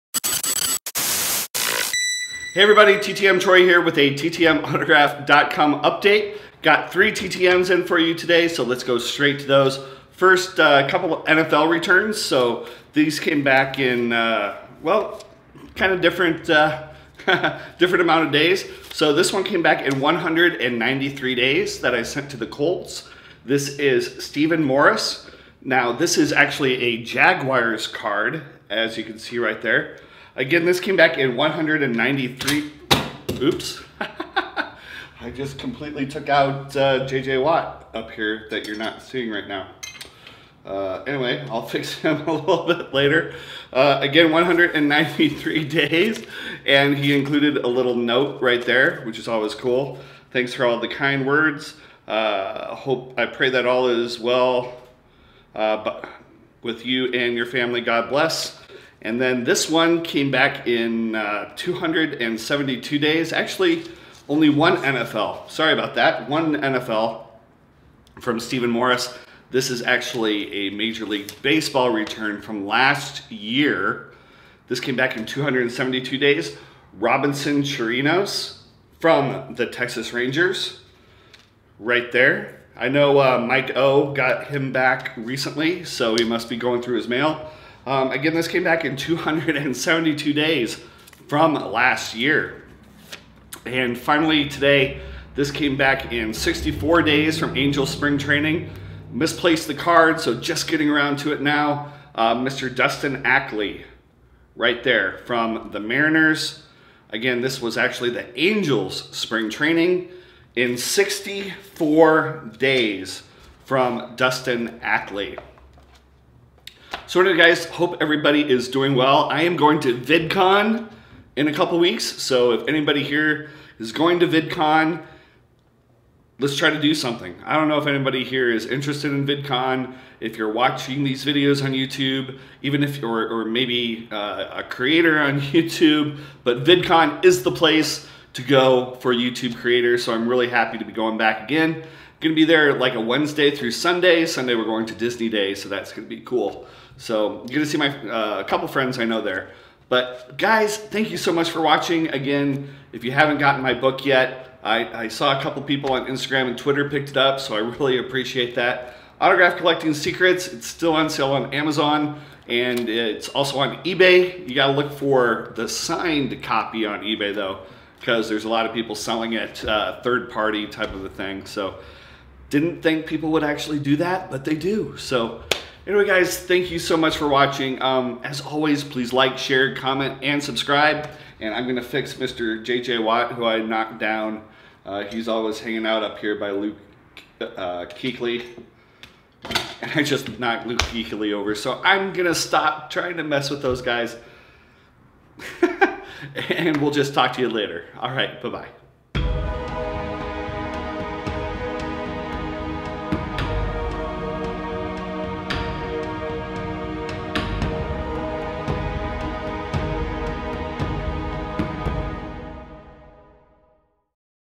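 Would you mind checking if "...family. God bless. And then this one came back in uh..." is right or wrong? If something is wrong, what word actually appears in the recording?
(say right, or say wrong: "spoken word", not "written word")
right.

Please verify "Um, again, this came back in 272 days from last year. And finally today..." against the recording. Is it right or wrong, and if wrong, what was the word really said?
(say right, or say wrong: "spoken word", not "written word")
right.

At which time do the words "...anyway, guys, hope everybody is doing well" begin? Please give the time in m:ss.
1:57.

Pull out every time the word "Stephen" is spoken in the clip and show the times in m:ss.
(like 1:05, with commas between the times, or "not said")
0:24, 1:08.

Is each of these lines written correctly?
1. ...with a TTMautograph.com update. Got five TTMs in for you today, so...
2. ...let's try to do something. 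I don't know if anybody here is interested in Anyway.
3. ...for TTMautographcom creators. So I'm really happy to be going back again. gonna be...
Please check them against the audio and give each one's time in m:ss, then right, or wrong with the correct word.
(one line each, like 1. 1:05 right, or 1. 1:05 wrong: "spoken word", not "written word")
1. 0:03 wrong: "three", not "five"
2. 2:06 wrong: "VidCon", not "Anyway"
3. 2:19 wrong: "YouTube", not "TTMautographcom".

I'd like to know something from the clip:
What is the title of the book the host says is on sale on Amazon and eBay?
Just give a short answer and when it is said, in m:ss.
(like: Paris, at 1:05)
Autograph Collecting Secrets, at 2:39.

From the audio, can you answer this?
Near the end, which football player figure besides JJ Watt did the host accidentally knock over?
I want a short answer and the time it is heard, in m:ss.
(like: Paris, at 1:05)
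Luke Kuechly, at 3:10.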